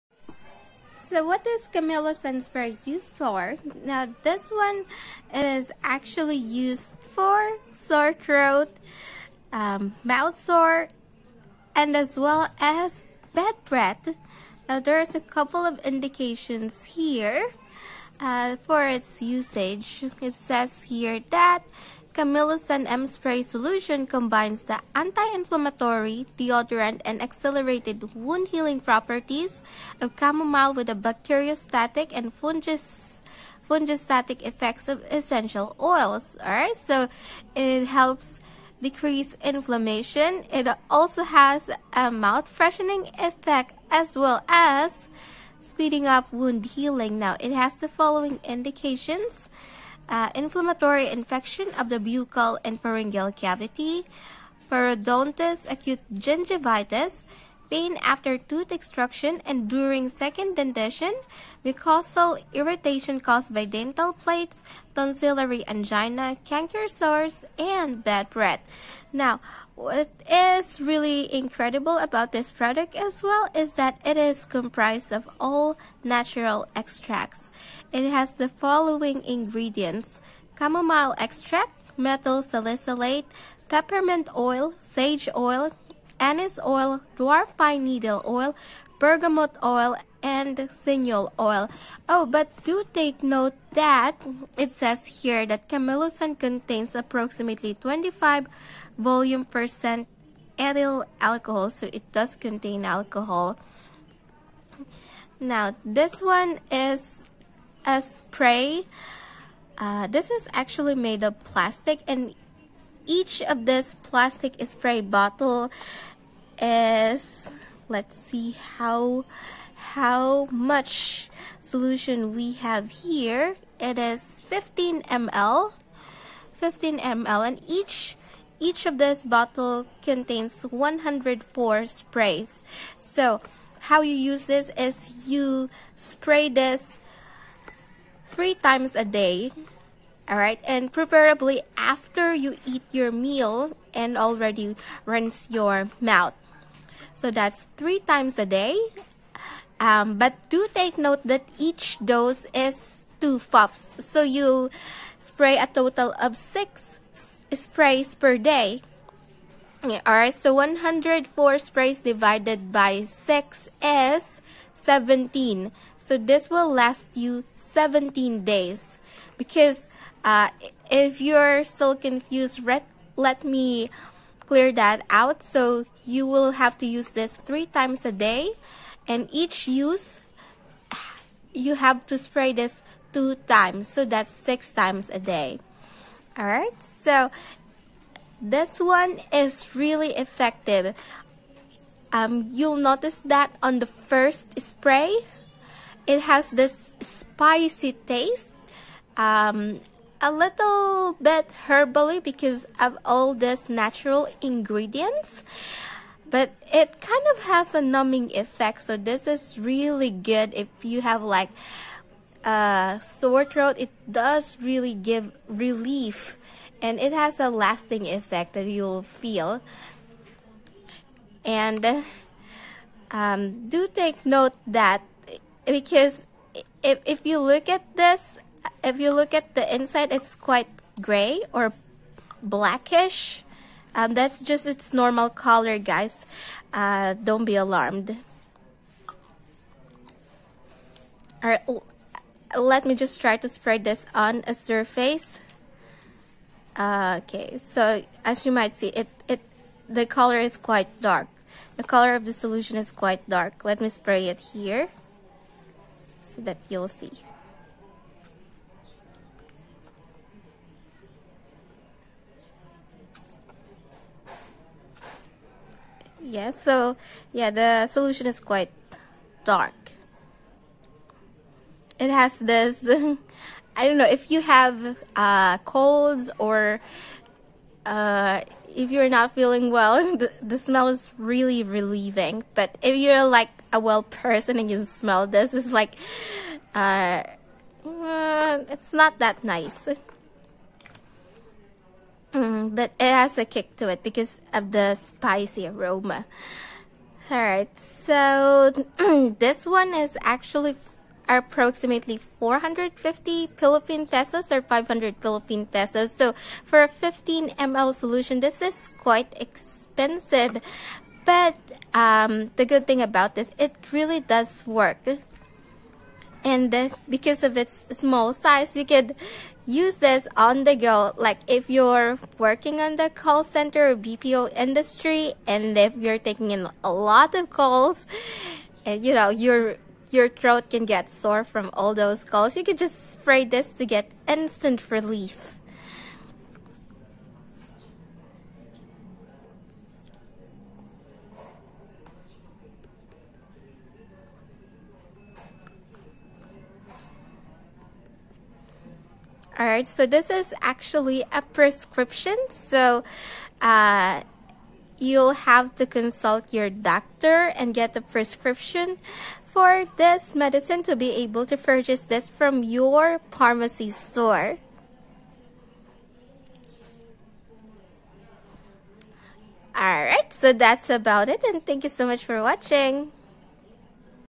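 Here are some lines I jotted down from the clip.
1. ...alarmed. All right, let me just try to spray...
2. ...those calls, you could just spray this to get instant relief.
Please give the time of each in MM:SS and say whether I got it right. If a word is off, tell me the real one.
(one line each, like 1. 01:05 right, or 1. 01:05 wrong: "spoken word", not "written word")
1. 03:57 right
2. 05:31 right.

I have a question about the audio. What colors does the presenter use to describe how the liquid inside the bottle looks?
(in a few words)
gray or blackish.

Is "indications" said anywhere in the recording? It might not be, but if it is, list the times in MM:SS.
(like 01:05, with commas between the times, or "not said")
00:15, 00:48.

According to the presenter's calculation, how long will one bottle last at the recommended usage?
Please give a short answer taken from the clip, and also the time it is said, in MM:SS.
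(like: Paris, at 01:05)
17 days, at 02:47.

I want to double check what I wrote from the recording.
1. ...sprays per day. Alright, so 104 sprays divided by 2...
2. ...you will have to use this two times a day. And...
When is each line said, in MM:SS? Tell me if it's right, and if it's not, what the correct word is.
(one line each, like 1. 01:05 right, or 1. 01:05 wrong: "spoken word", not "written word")
1. 02:37 wrong: "6", not "2"
2. 02:56 wrong: "three", not "two".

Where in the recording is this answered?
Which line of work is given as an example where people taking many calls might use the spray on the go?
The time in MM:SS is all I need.
05:23.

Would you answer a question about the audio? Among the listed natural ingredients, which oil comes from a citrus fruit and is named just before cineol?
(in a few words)
bergamot oil.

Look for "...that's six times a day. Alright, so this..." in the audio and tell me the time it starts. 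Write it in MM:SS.
03:04.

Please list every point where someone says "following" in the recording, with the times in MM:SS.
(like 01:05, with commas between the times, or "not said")
00:47, 01:18.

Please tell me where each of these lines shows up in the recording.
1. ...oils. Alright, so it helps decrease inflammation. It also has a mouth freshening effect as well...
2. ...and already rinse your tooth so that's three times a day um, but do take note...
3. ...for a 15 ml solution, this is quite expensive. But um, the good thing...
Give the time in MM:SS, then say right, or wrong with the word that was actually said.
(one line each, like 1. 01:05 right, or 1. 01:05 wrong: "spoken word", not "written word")
1. 00:35 right
2. 02:23 wrong: "mouth", not "tooth"
3. 05:06 right.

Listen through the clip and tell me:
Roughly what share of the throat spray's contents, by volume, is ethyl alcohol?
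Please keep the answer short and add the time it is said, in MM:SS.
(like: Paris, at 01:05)
25 volume percent, at 01:37.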